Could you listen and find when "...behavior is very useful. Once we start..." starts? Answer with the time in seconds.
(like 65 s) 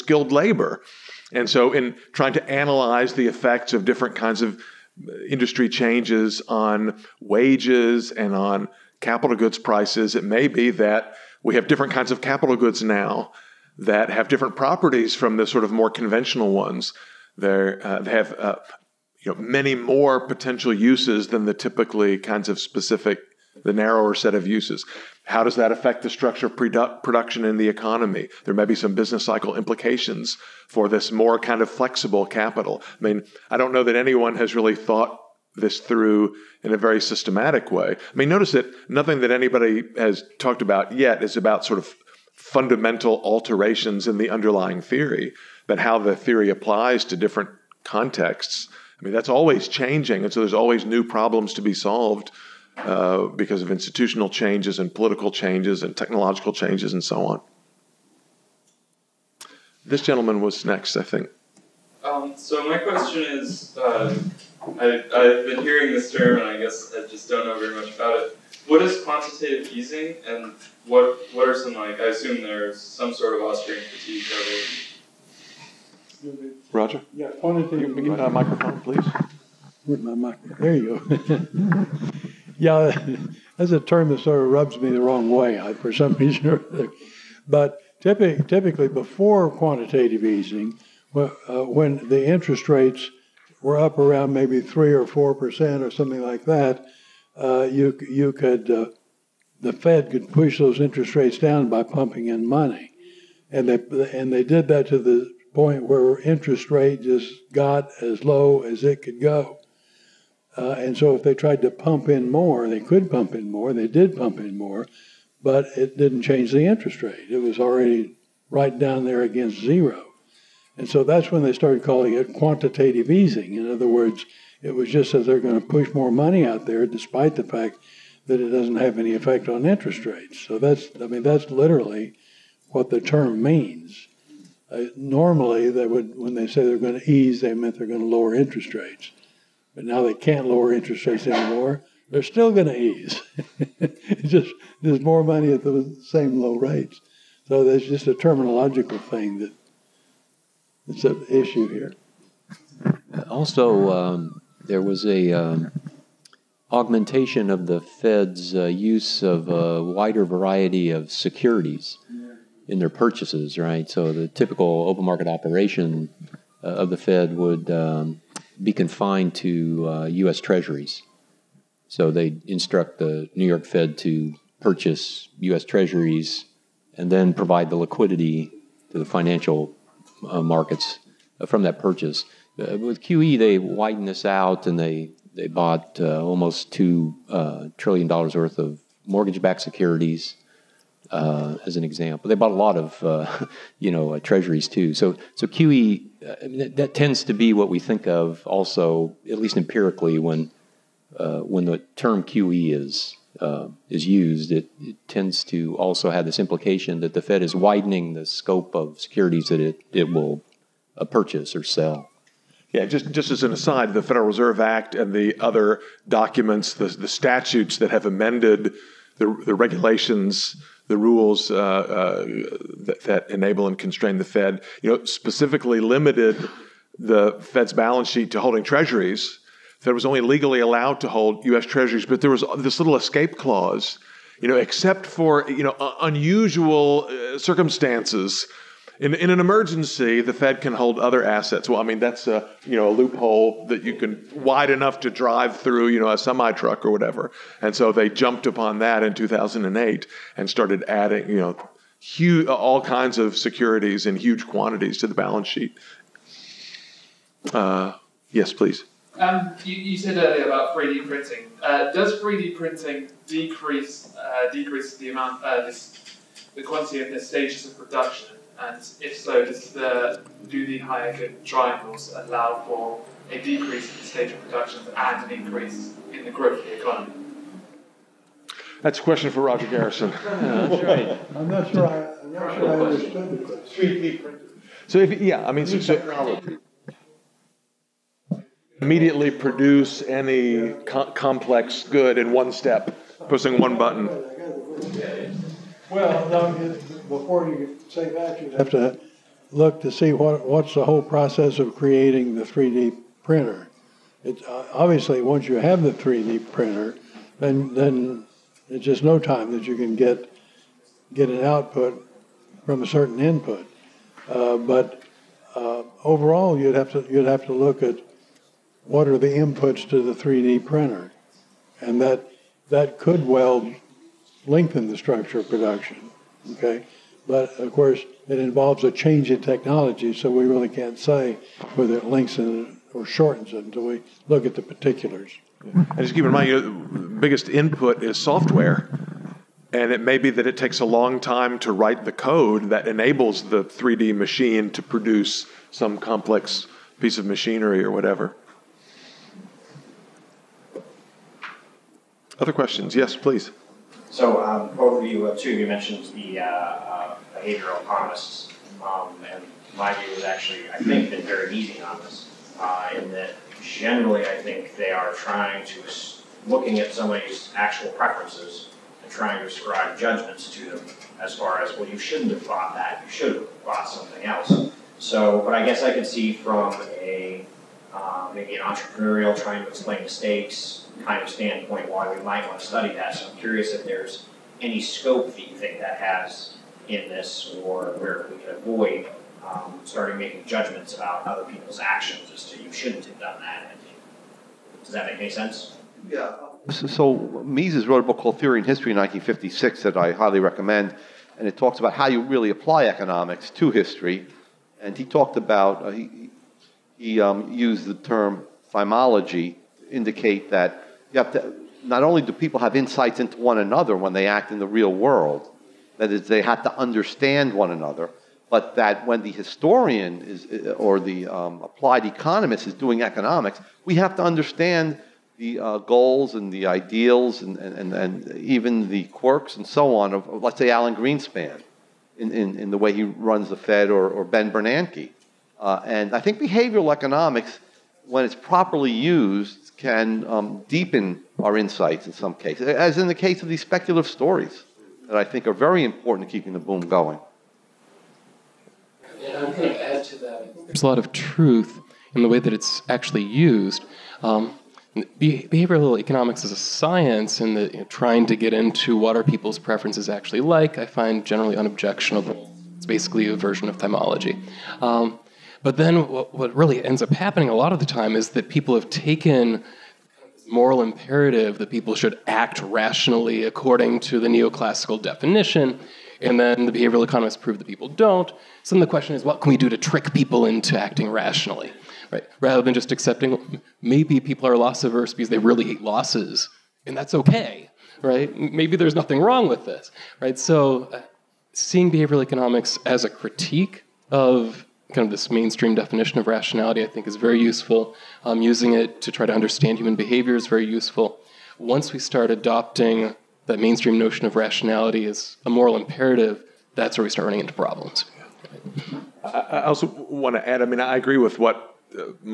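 499 s.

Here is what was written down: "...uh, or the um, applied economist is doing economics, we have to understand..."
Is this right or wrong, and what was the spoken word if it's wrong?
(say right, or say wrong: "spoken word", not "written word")
right.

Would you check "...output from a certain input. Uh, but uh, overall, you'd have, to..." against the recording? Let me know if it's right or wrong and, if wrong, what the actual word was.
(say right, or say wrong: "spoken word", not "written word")
right.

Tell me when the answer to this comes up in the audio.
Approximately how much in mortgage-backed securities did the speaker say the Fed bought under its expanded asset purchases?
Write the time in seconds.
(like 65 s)
186 s.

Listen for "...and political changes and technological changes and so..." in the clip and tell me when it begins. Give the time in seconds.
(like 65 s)
54 s.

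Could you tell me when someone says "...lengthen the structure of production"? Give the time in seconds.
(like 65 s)
324 s.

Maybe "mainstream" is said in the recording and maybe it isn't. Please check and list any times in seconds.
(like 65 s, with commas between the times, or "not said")
495 s, 503 s.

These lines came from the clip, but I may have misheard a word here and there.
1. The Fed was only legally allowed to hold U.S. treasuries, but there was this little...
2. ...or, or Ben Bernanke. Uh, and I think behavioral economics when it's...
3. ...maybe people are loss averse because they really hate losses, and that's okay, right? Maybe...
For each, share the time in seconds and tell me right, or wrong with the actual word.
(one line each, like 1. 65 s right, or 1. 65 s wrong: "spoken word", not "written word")
1. 229 s right
2. 433 s right
3. 483 s right.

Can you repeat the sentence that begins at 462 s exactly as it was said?
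It's basically a version of thymology.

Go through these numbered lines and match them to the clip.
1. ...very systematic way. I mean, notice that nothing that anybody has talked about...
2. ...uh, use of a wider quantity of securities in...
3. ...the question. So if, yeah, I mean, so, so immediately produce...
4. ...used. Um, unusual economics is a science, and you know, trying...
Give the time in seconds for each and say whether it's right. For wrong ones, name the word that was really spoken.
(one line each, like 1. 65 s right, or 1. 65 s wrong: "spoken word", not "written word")
1. 36 s right
2. 158 s wrong: "variety", not "quantity"
3. 283 s right
4. 453 s wrong: "behavioral", not "unusual".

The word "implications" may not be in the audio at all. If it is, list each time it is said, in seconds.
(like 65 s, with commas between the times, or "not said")
29 s, 206 s.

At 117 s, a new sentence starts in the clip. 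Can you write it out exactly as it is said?
It was already right down there against zero.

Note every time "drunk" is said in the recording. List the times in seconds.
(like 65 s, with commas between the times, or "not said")
not said.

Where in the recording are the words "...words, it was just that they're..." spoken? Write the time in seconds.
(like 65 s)
123 s.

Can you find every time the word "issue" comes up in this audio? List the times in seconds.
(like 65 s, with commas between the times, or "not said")
151 s.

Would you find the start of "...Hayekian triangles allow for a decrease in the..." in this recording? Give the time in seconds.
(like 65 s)
270 s.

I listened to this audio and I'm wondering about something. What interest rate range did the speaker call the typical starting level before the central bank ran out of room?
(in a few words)
3 or 4 percent.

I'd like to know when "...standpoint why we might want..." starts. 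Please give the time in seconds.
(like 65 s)
381 s.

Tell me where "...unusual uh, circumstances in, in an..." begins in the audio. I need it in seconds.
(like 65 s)
236 s.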